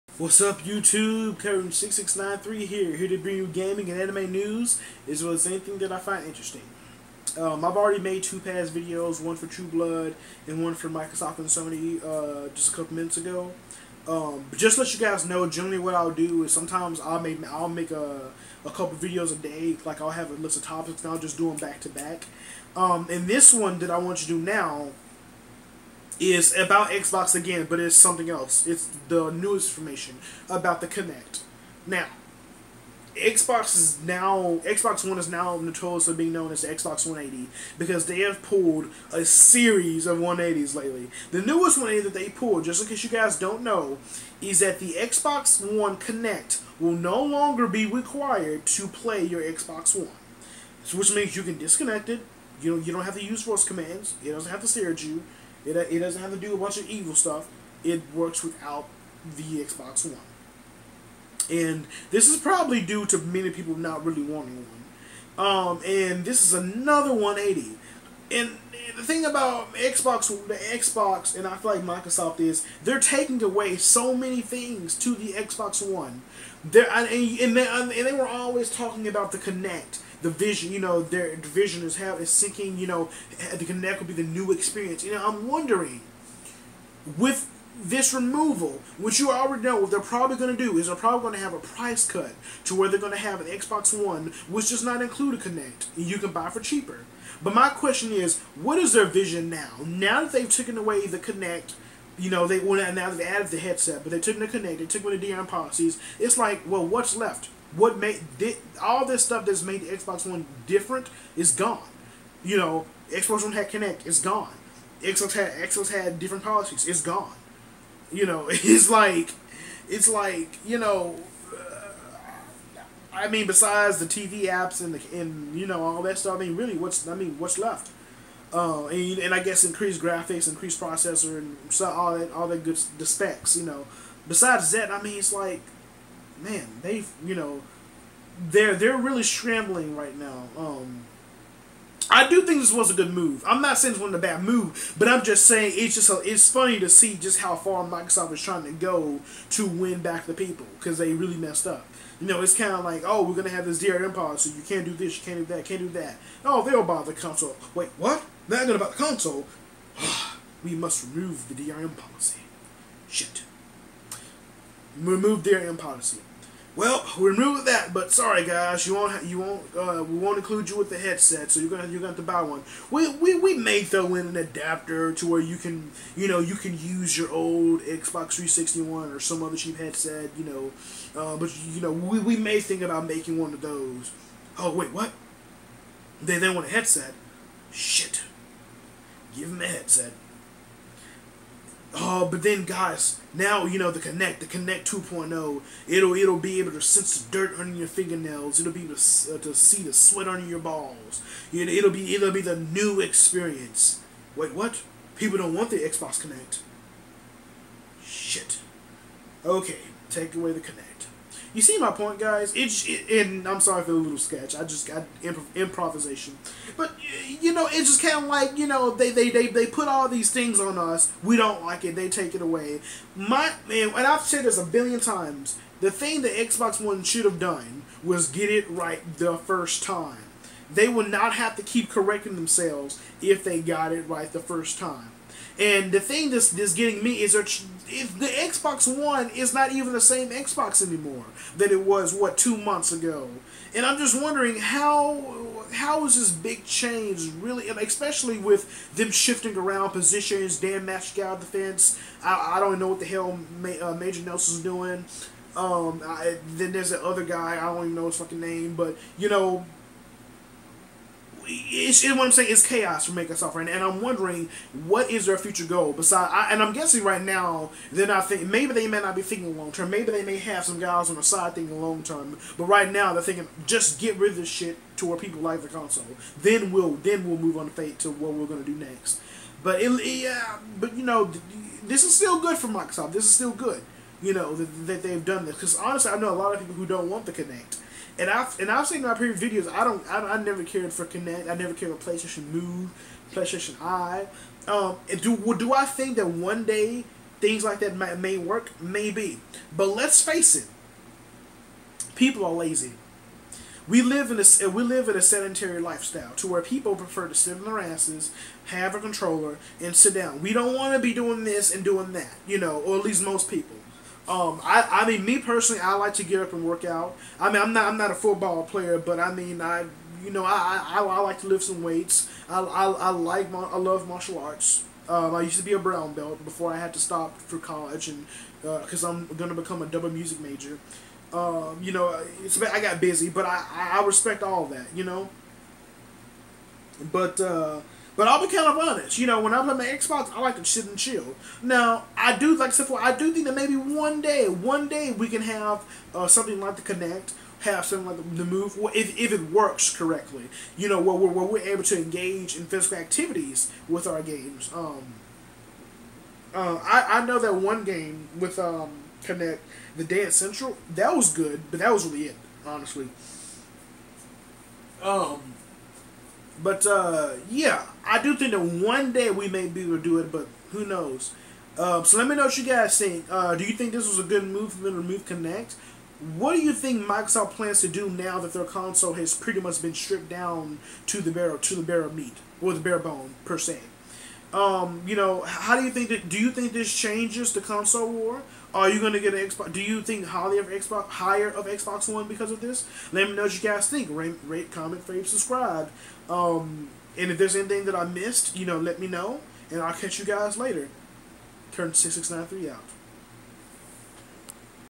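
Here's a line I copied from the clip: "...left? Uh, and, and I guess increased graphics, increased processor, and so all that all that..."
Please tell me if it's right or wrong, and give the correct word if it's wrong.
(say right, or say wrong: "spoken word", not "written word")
right.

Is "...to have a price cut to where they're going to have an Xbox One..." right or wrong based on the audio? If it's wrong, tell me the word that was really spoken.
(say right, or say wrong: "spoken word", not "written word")
right.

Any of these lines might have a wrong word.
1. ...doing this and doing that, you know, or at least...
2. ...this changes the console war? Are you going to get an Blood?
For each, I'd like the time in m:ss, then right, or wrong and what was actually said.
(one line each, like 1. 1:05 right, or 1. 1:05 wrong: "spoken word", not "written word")
1. 5:11 right
2. 6:26 wrong: "Xbox", not "Blood".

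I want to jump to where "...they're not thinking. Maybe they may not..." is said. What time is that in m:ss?
4:27.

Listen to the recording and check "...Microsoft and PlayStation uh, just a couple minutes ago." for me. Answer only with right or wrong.
wrong.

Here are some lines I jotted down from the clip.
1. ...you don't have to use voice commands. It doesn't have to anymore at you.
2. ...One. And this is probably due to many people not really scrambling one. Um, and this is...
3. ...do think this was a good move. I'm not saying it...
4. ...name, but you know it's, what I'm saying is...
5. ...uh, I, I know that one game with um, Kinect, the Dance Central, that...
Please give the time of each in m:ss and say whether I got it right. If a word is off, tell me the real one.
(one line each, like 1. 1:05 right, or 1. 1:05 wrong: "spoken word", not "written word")
1. 0:52 wrong: "stare", not "anymore"
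2. 1:00 wrong: "wanting", not "scrambling"
3. 2:22 right
4. 4:18 right
5. 5:56 right.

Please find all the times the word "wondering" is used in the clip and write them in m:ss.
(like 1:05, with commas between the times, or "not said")
1:25, 4:04, 4:24.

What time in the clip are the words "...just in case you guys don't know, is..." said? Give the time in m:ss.
0:42.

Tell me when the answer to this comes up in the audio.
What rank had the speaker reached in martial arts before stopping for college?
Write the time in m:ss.
5:25.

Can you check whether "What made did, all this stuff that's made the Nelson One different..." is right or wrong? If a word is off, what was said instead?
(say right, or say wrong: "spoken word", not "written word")
wrong: "Xbox", not "Nelson".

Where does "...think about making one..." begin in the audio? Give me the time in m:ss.
3:02.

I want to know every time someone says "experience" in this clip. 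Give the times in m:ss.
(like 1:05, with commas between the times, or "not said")
1:24, 3:23.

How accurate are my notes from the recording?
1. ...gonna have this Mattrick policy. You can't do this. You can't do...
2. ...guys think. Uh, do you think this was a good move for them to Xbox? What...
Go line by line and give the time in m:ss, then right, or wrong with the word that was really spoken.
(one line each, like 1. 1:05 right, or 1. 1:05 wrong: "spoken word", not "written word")
1. 2:33 wrong: "DRM", not "Mattrick"
2. 6:12 wrong: "Kinect", not "Xbox".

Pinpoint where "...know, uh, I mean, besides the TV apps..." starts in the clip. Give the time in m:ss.
2:00.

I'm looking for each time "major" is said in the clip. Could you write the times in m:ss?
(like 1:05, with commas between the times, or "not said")
4:13, 5:30.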